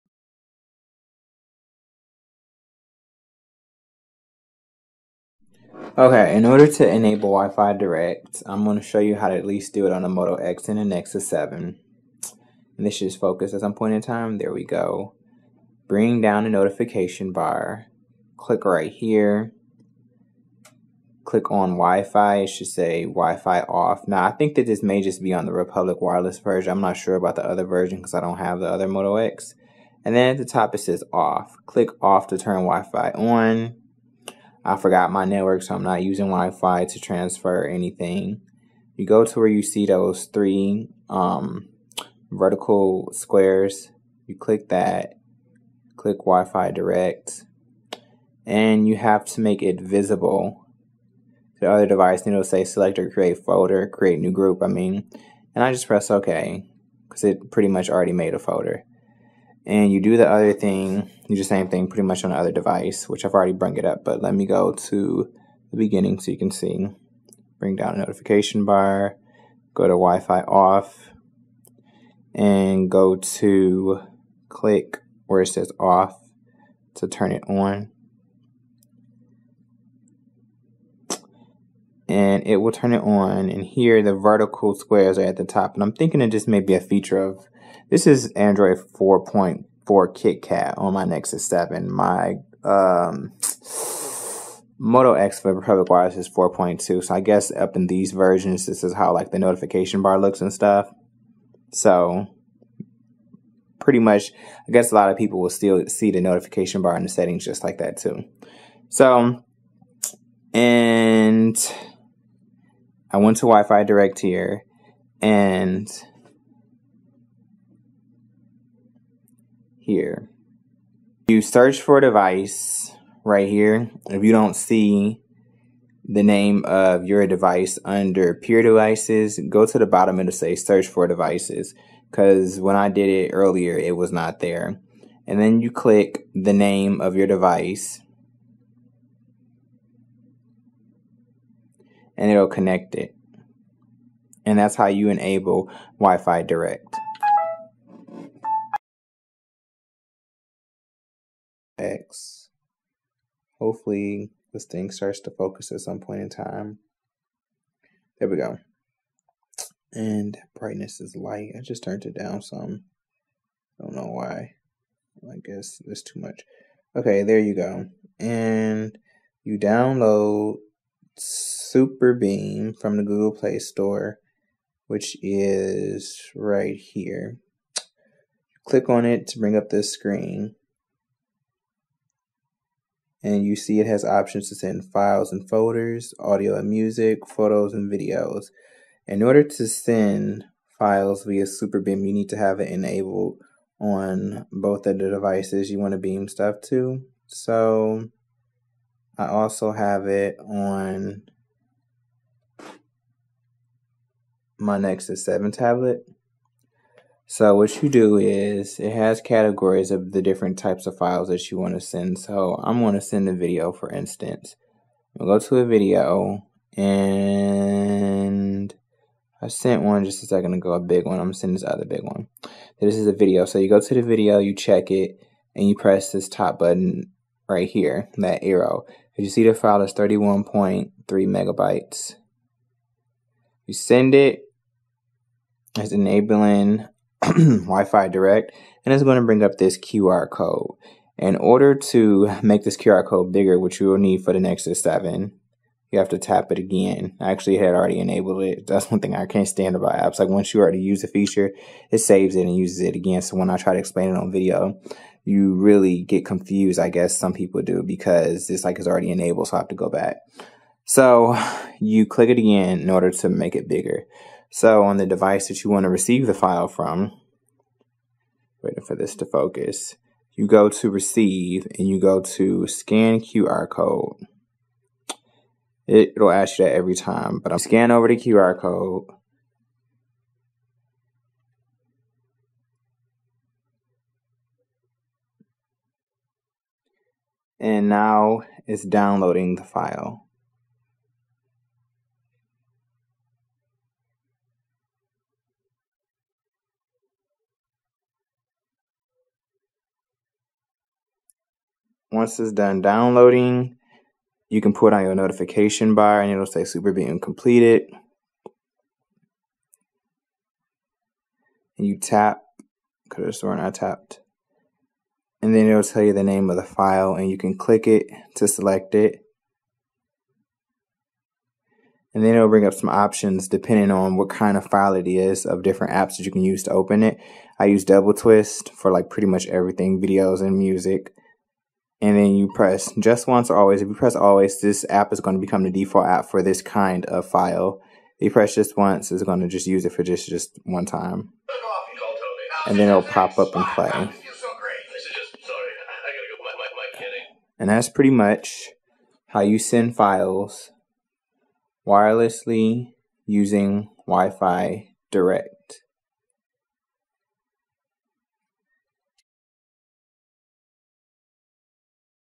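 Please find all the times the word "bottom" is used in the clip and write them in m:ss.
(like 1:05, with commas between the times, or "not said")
2:09.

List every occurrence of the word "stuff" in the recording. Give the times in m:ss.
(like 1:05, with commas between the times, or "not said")
1:40, 3:16.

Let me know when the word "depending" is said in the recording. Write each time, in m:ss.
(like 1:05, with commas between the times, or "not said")
5:23.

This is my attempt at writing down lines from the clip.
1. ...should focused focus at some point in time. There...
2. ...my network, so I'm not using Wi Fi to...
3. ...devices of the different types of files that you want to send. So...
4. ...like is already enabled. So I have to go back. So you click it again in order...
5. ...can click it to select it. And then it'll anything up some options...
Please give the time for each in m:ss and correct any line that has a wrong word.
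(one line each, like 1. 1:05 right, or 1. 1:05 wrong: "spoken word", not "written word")
1. 0:12 right
2. 0:35 right
3. 3:29 wrong: "categories", not "devices"
4. 4:18 right
5. 5:17 wrong: "bring", not "anything".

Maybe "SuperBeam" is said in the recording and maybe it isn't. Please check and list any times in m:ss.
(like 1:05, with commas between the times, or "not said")
2:51, 3:11, 5:06.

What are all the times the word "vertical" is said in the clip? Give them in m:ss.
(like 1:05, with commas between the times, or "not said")
0:42, 1:24.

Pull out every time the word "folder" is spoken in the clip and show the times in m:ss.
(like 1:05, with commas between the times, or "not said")
0:53, 0:58, 3:05.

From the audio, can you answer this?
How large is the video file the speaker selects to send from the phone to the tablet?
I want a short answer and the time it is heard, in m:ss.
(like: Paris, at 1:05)
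31.3 megabytes, at 3:49.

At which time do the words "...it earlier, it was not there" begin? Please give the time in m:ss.
2:13.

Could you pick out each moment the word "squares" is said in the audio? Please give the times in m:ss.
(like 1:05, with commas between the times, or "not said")
0:43, 1:24.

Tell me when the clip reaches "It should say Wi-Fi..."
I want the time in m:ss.
0:22.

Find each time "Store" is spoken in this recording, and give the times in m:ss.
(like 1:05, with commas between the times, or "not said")
2:53.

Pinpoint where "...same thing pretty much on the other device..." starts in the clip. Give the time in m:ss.
1:01.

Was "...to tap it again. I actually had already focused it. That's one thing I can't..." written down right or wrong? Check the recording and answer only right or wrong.
wrong.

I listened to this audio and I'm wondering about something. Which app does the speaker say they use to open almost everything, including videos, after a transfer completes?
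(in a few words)
doubleTwist.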